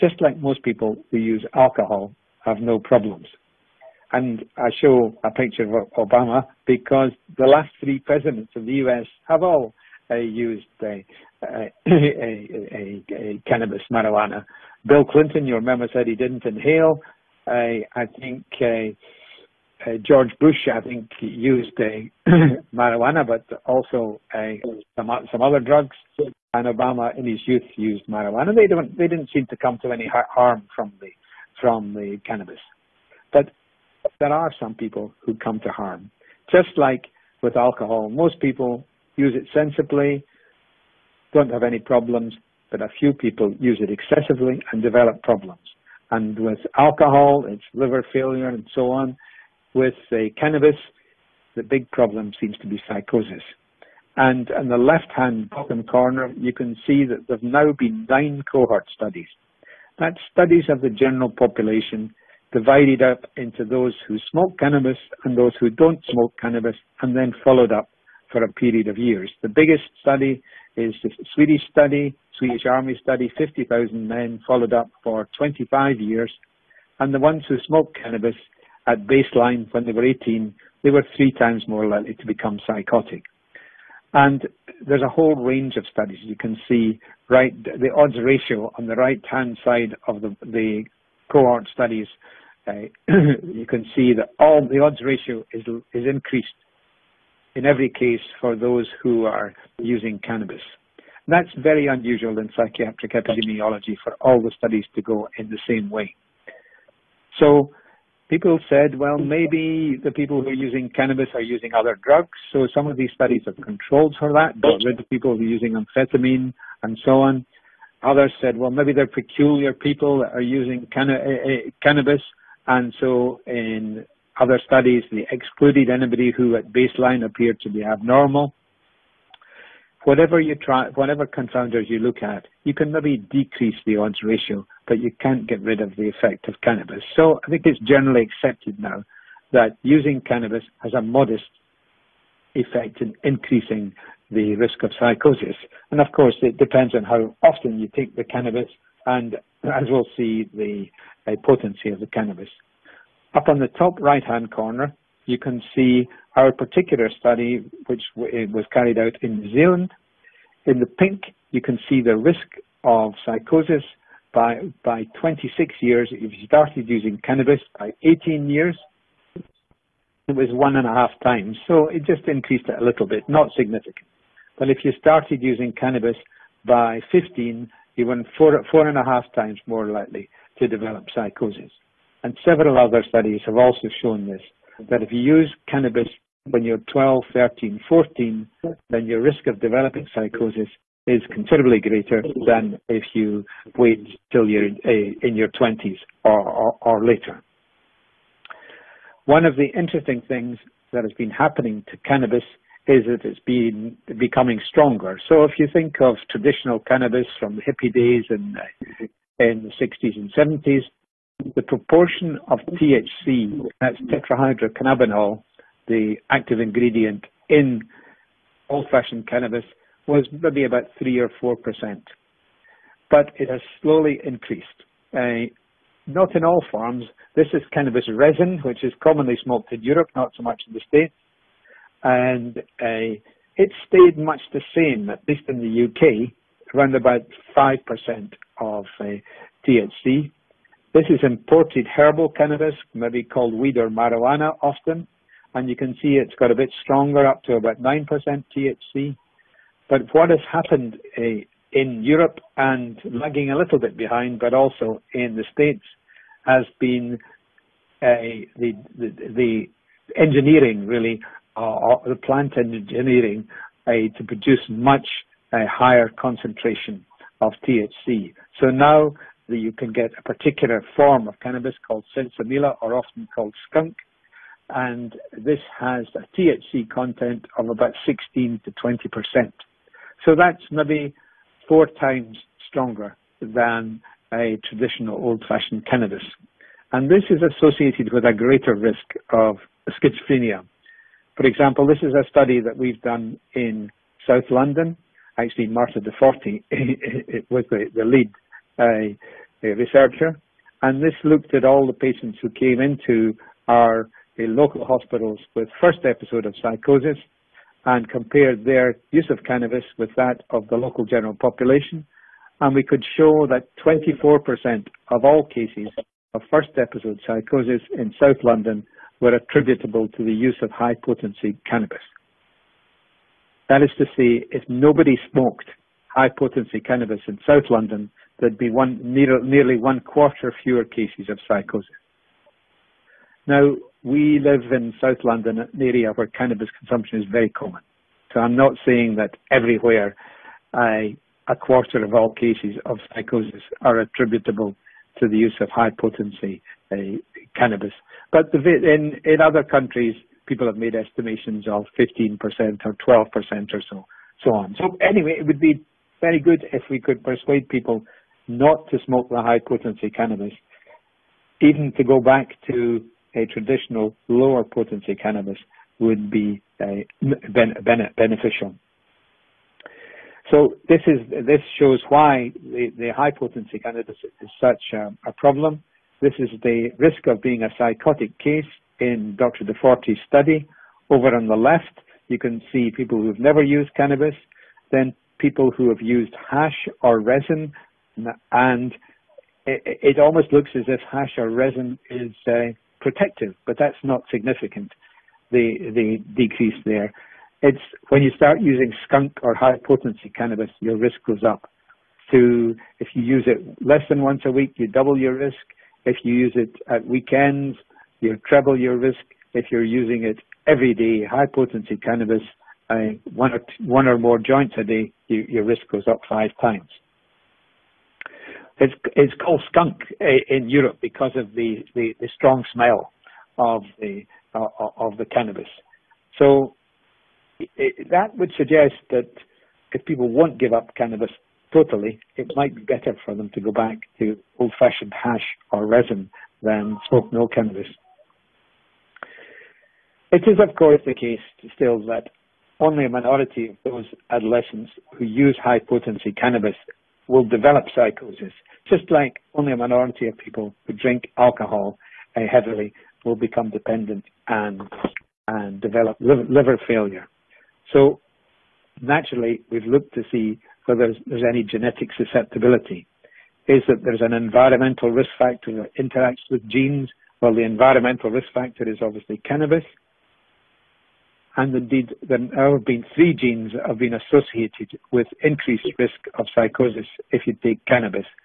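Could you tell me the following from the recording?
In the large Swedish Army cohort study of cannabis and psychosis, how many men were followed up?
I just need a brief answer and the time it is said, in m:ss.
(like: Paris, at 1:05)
50,000, at 1:13.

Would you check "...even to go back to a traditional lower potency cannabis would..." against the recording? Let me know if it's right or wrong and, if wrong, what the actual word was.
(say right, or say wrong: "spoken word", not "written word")
right.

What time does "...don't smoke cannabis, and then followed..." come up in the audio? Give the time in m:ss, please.
1:05.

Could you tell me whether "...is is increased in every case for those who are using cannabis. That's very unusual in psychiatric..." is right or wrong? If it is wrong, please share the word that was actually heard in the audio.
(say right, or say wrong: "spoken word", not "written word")
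right.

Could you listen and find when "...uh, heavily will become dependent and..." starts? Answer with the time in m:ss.
7:32.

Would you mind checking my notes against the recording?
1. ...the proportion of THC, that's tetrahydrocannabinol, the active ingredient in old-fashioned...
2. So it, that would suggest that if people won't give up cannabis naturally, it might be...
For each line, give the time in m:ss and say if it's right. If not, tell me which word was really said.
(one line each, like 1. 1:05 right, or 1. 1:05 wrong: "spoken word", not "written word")
1. 3:31 right
2. 7:06 wrong: "totally", not "naturally".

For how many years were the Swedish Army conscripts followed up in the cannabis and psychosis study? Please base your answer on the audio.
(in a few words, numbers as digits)
25 years.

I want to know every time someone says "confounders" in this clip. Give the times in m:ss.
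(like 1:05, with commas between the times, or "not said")
2:11.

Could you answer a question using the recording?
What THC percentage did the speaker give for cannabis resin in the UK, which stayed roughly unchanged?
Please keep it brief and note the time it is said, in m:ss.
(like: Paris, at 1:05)
5%, at 3:57.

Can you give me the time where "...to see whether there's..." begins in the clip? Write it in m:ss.
7:40.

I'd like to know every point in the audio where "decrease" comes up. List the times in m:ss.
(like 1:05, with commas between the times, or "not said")
2:13, 6:36.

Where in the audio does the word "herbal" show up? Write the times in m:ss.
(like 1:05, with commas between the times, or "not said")
4:01.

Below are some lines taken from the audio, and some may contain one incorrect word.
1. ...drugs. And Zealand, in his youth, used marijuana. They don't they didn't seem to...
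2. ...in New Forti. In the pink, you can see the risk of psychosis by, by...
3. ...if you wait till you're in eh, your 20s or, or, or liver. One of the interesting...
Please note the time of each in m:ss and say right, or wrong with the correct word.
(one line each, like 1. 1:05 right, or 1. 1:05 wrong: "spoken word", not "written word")
1. 0:25 wrong: "Obama", not "Zealand"
2. 2:39 wrong: "Zealand", not "Forti"
3. 3:12 wrong: "later", not "liver".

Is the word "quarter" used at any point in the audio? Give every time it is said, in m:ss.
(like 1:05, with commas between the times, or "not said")
5:30, 5:41.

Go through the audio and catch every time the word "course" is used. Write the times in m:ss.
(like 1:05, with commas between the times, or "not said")
2:26, 7:20.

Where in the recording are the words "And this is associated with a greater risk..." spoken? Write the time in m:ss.
4:46.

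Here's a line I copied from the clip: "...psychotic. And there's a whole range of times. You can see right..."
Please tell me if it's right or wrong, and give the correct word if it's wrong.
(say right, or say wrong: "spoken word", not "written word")
wrong: "studies", not "times".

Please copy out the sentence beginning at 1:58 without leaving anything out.
Others said, well, maybe they're peculiar people that are using canna- uh, uh, cannabis.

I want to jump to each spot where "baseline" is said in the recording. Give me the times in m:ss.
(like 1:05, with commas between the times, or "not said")
1:19, 2:06.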